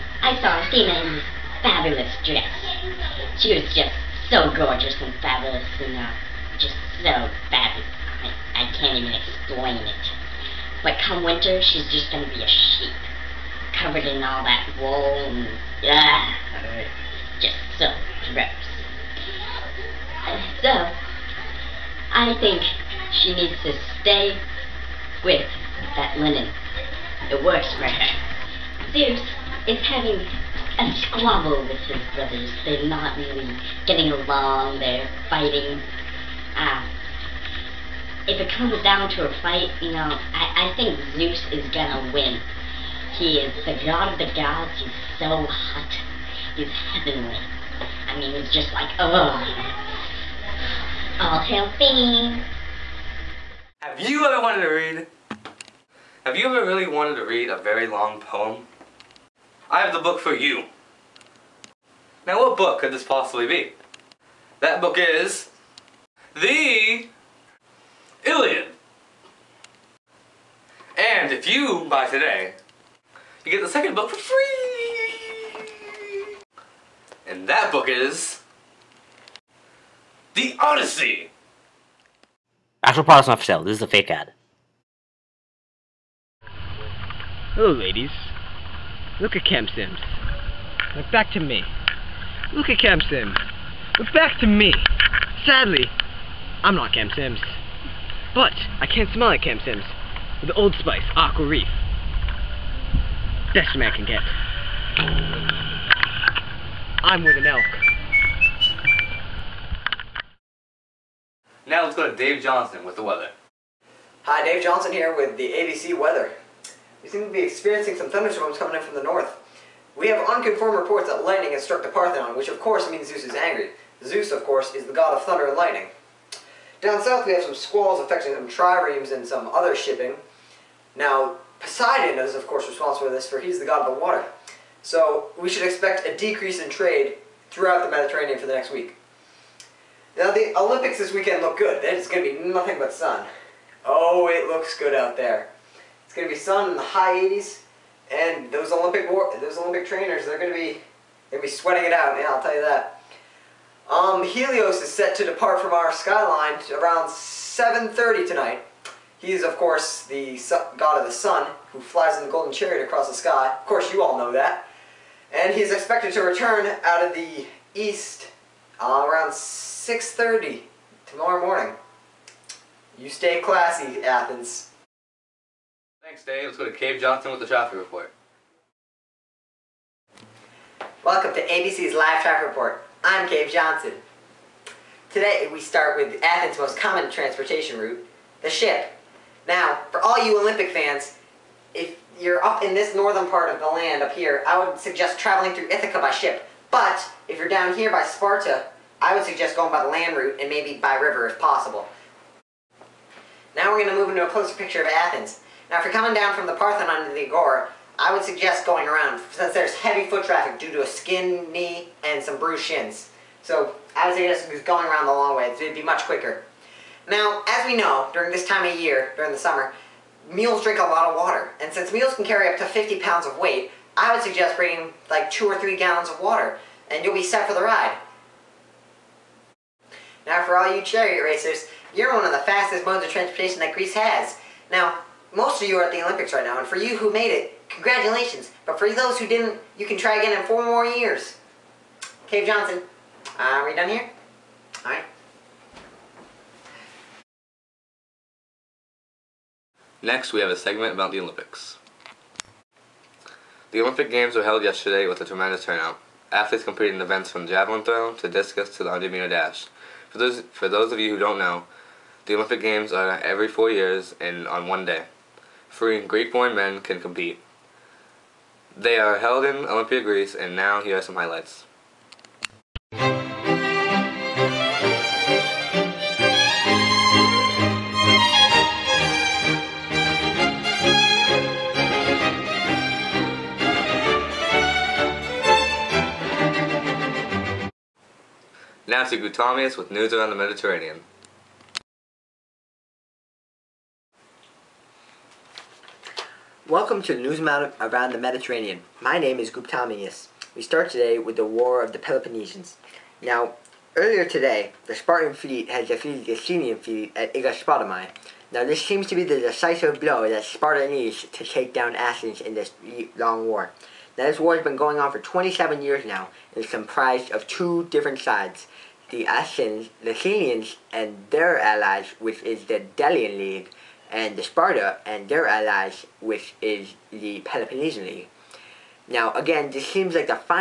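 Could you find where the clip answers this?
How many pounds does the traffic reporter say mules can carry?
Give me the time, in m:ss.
3:42.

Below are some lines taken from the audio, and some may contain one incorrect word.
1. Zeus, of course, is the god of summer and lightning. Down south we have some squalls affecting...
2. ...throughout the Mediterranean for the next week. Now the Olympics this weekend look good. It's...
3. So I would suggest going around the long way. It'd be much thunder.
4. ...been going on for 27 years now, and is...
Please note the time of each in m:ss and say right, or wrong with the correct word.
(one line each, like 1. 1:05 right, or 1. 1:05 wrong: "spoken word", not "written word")
1. 2:04 wrong: "thunder", not "summer"
2. 2:17 right
3. 3:33 wrong: "quicker", not "thunder"
4. 5:14 right.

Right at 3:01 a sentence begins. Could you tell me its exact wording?
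Welcome to ABC's Live Traffic Report.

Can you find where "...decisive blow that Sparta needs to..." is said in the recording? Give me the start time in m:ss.
5:09.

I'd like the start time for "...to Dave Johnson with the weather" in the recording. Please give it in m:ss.
1:52.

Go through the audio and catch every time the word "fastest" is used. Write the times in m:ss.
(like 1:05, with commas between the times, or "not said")
3:52.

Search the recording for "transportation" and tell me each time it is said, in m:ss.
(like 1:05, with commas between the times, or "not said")
3:07, 3:53.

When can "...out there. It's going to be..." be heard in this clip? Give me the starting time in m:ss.
2:24.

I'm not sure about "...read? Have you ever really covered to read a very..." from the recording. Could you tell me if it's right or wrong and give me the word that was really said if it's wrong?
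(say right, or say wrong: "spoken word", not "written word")
wrong: "wanted", not "covered".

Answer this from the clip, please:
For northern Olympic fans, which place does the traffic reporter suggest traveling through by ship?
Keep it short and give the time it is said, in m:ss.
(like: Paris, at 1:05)
Ithaca, at 3:15.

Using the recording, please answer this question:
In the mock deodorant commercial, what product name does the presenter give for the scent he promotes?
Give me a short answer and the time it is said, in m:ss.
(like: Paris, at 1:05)
Old Spice Aqua Reef, at 1:40.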